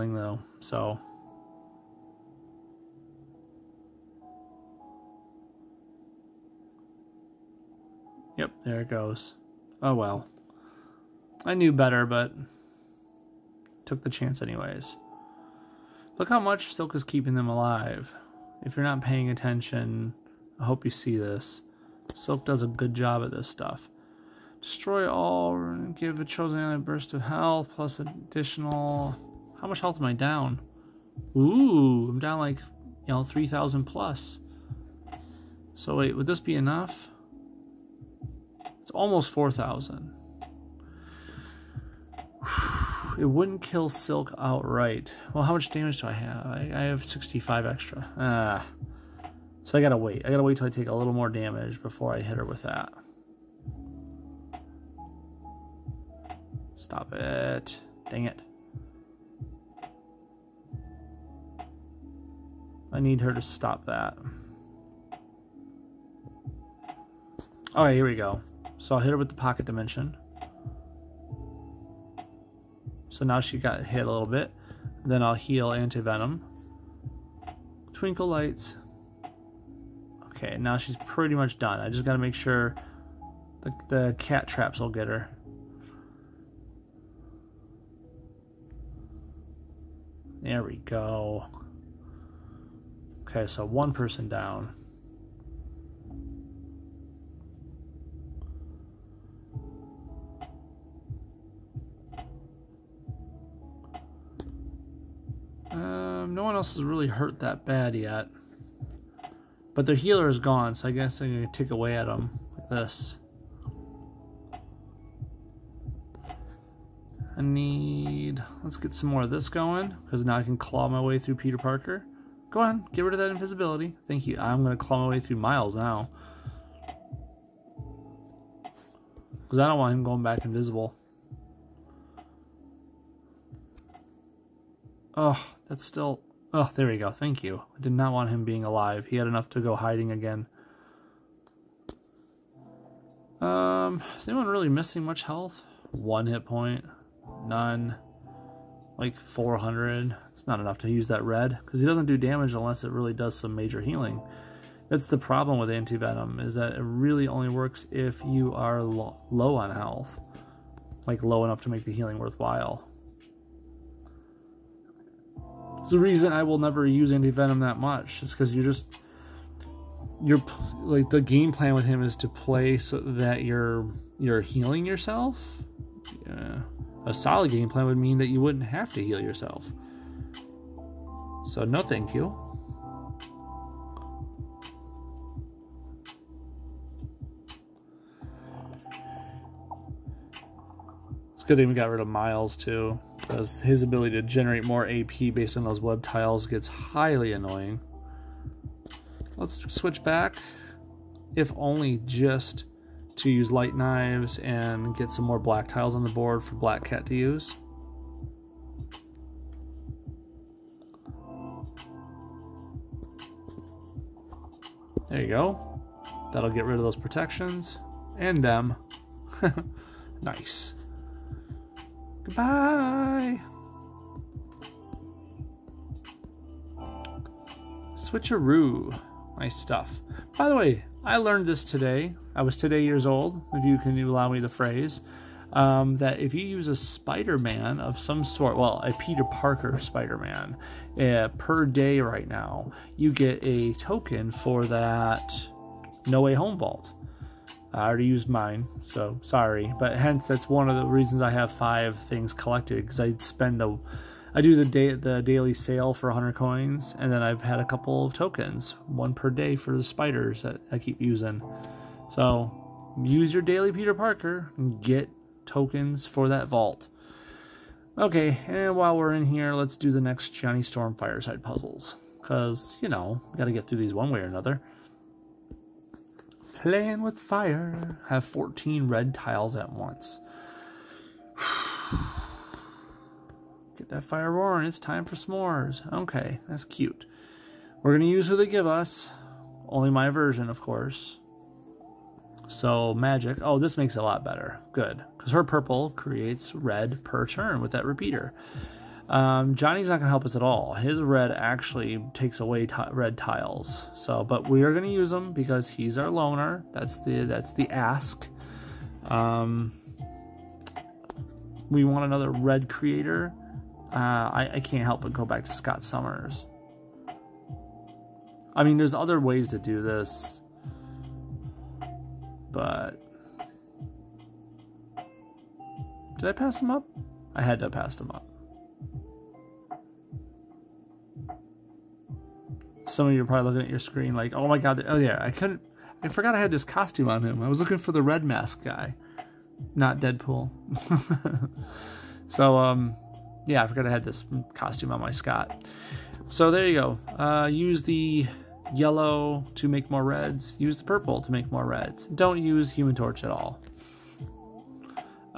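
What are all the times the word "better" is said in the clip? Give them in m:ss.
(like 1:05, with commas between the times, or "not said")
0:11, 4:54.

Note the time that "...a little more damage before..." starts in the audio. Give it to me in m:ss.
0:50.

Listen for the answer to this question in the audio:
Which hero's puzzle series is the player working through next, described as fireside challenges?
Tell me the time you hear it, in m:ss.
4:30.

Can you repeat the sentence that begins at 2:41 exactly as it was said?
Like, low enough to make the healing worthwhile.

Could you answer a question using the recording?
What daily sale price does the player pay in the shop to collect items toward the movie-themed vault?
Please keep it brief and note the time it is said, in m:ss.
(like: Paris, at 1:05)
100 coins, at 4:16.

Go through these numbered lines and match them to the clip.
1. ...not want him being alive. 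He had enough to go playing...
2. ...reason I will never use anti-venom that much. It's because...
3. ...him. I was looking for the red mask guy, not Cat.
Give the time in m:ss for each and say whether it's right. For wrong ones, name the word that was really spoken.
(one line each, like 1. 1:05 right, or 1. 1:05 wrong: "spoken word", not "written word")
1. 2:17 wrong: "hiding", not "playing"
2. 2:45 right
3. 5:37 wrong: "Deadpool", not "Cat".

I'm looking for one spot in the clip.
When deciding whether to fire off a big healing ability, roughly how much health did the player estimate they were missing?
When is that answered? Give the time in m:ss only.
0:33.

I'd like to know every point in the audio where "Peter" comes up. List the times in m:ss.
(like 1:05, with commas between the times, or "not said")
2:01, 3:58, 4:23.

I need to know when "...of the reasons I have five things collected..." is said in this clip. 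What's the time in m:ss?
4:10.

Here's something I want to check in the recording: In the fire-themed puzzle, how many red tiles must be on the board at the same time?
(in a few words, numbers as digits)
14.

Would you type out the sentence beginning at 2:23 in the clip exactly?
Um, is anyone really missing much health?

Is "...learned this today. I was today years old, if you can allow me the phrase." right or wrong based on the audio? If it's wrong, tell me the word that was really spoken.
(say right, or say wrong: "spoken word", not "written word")
right.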